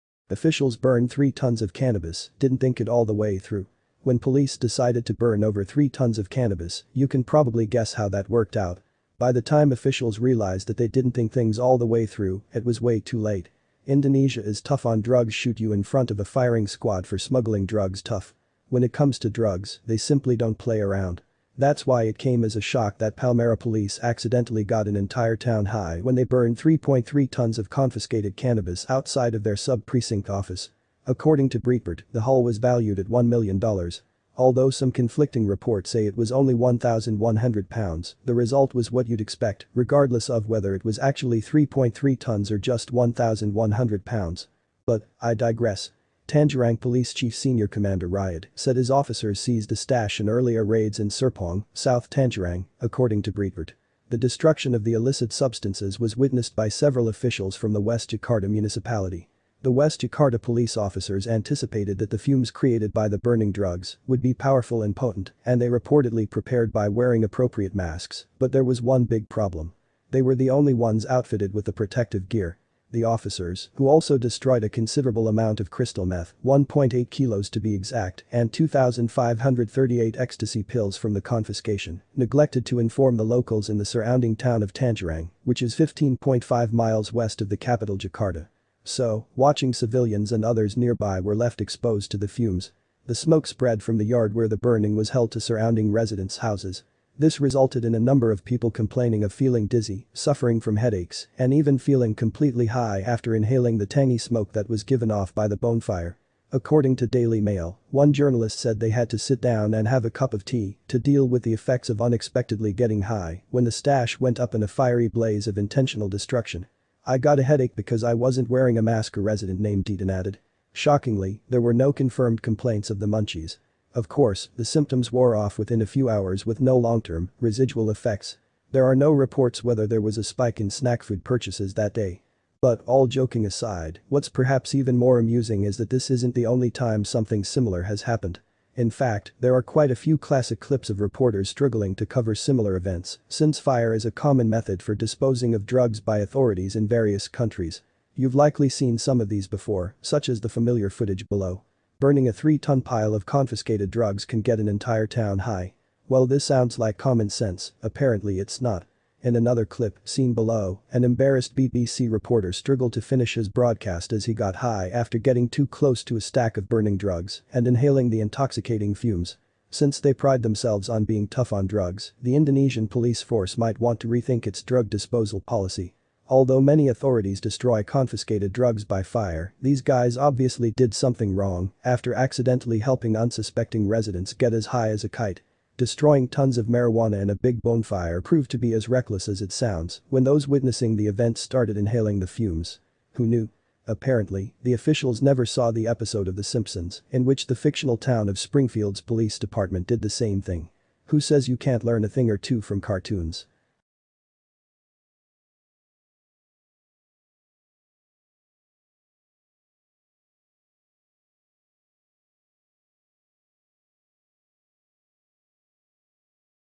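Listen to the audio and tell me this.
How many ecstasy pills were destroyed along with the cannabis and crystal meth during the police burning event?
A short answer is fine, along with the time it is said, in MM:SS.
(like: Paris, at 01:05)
2,538, at 01:18.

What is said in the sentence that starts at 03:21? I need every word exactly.
Who says you can't learn a thing or two from cartoons?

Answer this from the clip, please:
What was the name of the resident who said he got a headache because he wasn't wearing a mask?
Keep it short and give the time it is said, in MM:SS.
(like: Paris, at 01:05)
Deaton, at 01:59.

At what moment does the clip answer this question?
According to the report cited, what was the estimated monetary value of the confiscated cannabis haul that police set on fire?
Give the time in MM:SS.
00:33.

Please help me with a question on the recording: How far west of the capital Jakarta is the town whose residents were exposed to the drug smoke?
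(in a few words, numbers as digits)
15.5 miles.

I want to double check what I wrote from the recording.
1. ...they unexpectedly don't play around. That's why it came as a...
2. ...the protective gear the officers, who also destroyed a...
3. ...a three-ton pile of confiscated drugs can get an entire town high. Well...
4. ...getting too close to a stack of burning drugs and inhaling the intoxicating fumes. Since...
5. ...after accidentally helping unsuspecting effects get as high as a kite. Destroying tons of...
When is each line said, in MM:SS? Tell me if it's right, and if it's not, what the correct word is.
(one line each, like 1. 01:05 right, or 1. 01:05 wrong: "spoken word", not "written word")
1. 00:19 wrong: "simply", not "unexpectedly"
2. 01:11 right
3. 02:32 right
4. 02:45 right
5. 03:01 wrong: "residents", not "effects".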